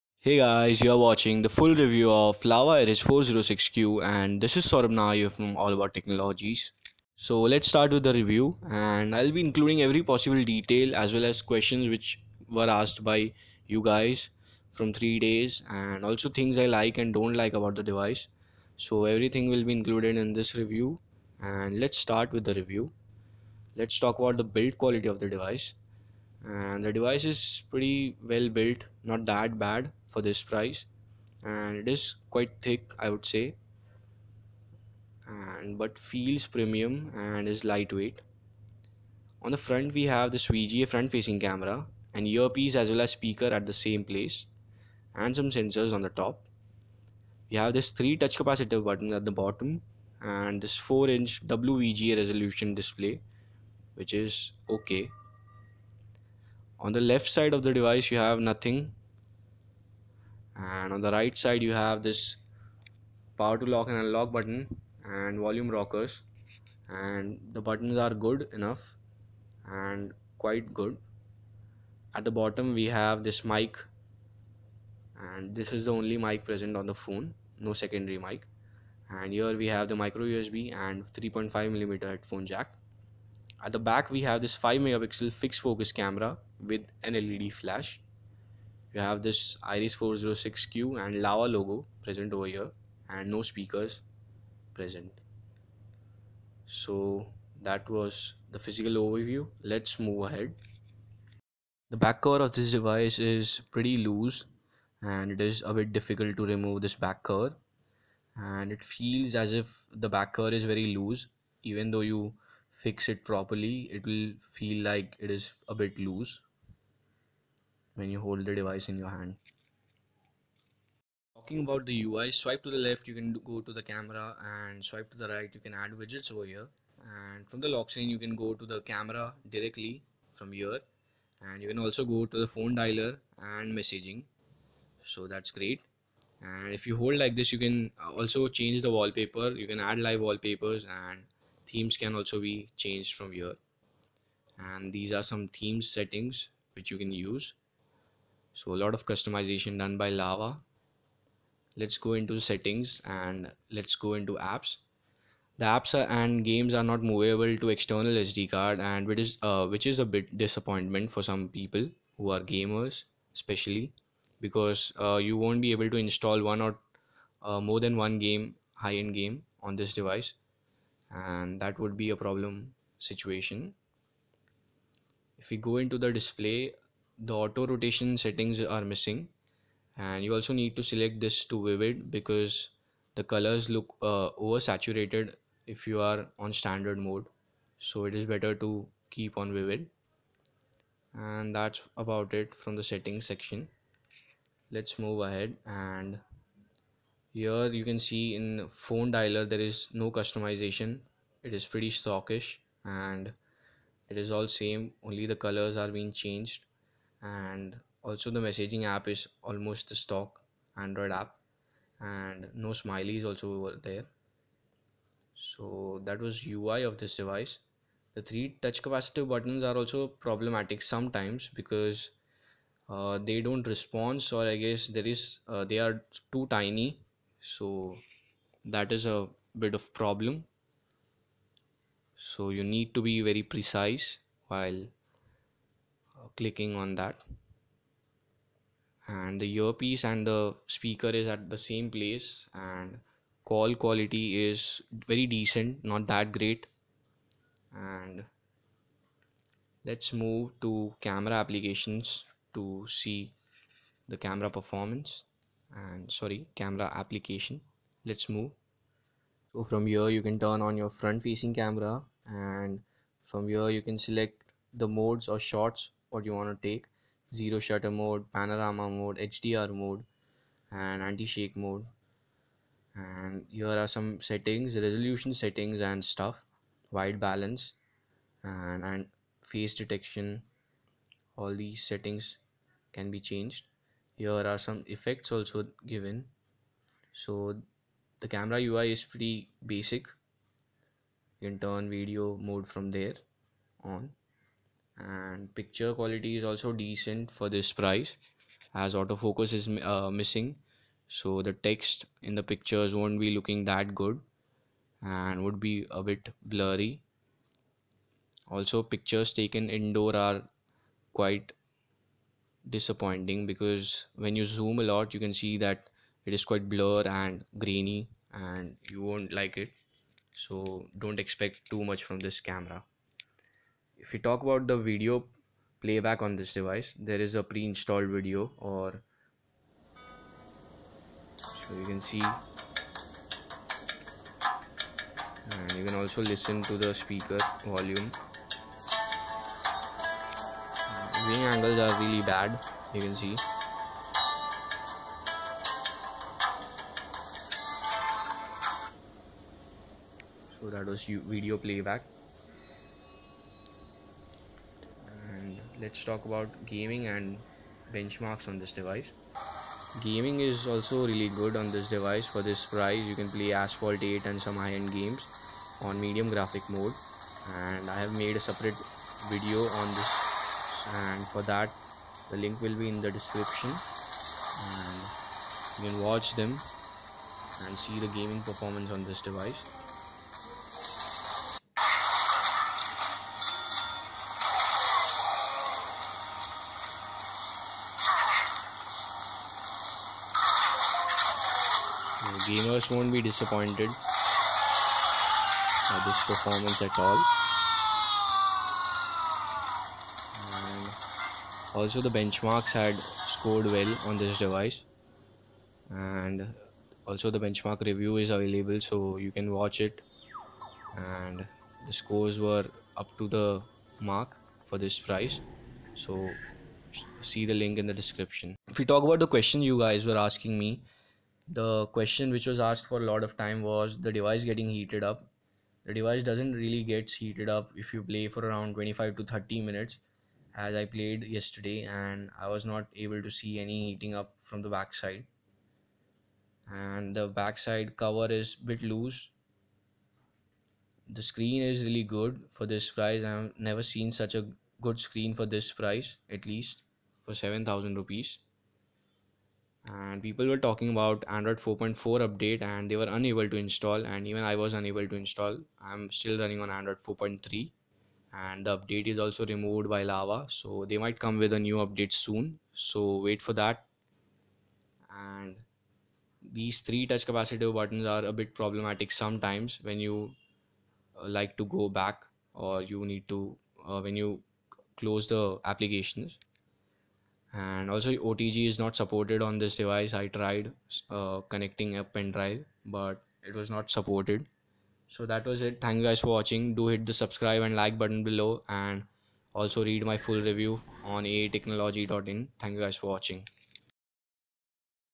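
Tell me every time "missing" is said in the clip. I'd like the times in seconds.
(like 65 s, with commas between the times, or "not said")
178 s, 300 s.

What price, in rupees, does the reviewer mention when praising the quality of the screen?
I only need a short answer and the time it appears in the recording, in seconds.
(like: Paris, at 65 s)
7000 rupees, at 447 s.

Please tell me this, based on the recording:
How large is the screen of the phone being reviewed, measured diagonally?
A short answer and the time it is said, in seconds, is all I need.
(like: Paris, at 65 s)
4 inch, at 50 s.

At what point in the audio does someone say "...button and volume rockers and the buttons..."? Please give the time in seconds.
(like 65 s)
64 s.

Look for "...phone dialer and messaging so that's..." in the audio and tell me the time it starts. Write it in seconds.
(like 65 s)
132 s.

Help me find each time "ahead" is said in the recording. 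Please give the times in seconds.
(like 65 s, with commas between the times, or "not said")
100 s, 195 s.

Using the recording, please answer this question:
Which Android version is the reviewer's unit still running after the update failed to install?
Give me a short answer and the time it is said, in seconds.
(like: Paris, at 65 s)
Android 4.3, at 456 s.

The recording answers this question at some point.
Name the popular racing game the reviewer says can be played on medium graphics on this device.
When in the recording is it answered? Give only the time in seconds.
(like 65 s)
363 s.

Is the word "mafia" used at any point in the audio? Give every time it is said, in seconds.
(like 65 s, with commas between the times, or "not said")
not said.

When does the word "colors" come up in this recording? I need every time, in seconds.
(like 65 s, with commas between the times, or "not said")
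183 s, 205 s.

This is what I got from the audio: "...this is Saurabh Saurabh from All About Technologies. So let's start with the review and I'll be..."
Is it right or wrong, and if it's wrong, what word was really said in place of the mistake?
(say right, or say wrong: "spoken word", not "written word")
wrong: "Nair", not "Saurabh".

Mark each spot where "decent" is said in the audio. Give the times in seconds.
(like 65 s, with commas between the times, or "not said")
245 s, 296 s.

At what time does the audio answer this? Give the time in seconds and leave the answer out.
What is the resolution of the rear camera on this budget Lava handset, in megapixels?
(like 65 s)
84 s.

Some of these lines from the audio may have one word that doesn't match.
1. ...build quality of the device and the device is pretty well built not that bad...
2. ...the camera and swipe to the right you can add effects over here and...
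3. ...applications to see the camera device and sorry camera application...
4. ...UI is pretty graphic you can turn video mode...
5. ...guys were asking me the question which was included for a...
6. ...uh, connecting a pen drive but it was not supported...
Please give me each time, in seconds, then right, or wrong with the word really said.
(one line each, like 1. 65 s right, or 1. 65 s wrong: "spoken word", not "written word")
1. 24 s right
2. 123 s wrong: "widgets", not "effects"
3. 251 s wrong: "performance", not "device"
4. 288 s wrong: "basic", not "graphic"
5. 419 s wrong: "asked", not "included"
6. 481 s right.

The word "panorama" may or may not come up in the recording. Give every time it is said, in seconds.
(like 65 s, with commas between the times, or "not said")
268 s.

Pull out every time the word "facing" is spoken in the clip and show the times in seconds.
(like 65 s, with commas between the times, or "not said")
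41 s, 261 s.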